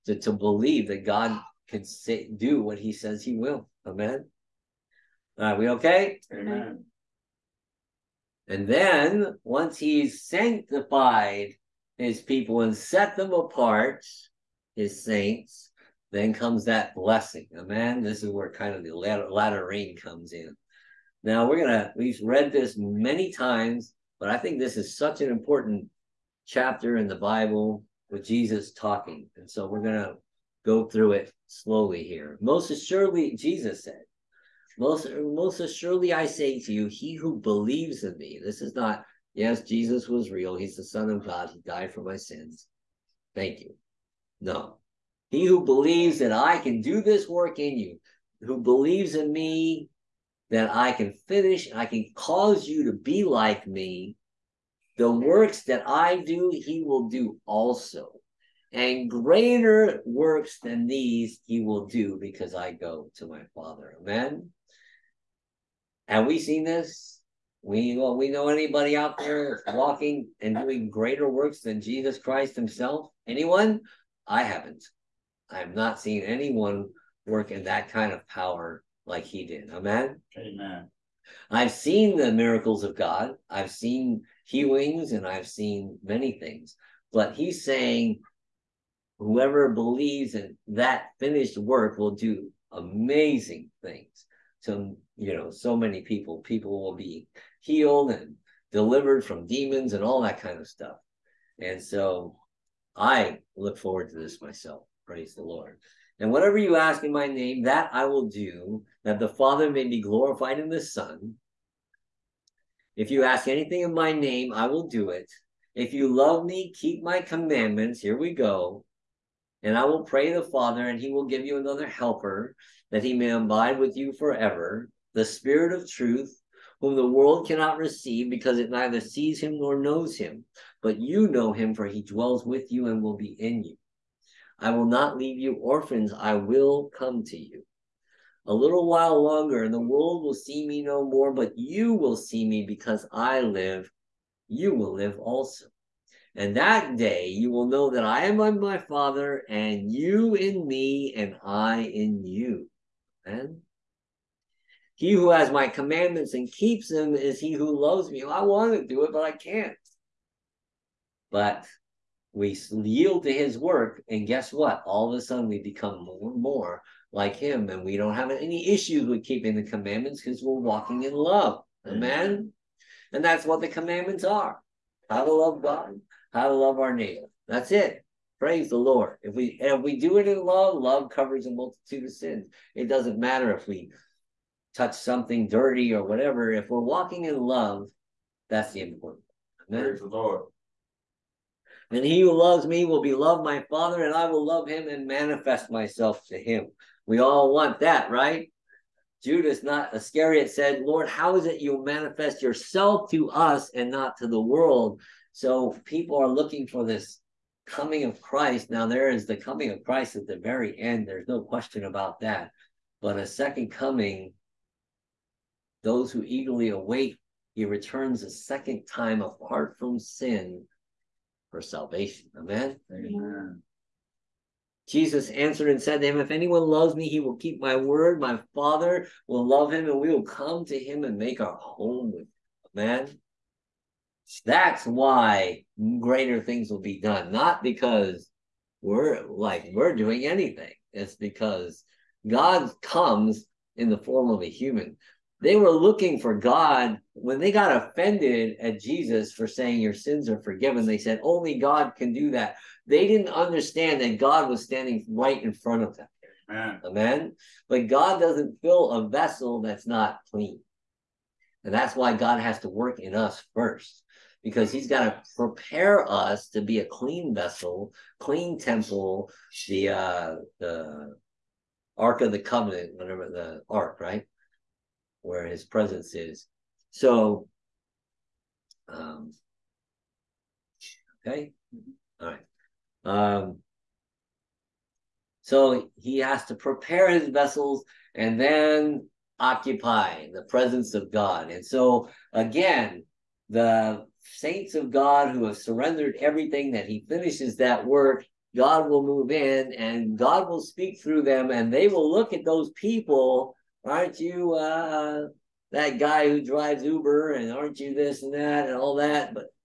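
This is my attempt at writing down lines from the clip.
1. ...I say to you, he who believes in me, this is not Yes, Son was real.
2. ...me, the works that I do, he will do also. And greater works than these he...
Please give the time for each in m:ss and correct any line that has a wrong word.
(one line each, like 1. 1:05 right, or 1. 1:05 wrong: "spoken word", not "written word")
1. 0:36 wrong: "Jesus", not "Son"
2. 0:53 right.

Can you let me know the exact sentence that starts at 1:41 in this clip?
And so I look forward to this myself.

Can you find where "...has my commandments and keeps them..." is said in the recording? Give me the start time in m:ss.
2:35.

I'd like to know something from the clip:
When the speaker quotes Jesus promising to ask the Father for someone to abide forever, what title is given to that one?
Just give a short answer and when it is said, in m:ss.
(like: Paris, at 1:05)
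Spirit of truth, at 2:05.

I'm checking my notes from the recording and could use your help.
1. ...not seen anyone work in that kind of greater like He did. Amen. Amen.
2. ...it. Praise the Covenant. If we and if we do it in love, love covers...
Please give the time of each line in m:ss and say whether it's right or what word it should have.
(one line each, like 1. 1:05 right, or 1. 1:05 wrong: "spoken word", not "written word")
1. 1:15 wrong: "power", not "greater"
2. 2:57 wrong: "Lord", not "Covenant".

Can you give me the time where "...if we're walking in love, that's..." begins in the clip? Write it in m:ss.
3:06.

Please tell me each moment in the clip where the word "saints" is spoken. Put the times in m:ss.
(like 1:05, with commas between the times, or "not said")
0:15, 4:54.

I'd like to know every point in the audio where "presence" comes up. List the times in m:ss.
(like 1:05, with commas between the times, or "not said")
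4:35, 4:50.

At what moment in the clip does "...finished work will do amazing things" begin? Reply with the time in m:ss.
1:31.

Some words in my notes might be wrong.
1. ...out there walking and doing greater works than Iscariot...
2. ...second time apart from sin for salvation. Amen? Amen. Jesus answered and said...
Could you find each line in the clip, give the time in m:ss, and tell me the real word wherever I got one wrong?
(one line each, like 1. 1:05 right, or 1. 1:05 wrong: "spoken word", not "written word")
1. 1:08 wrong: "Jesus", not "Iscariot"
2. 3:38 right.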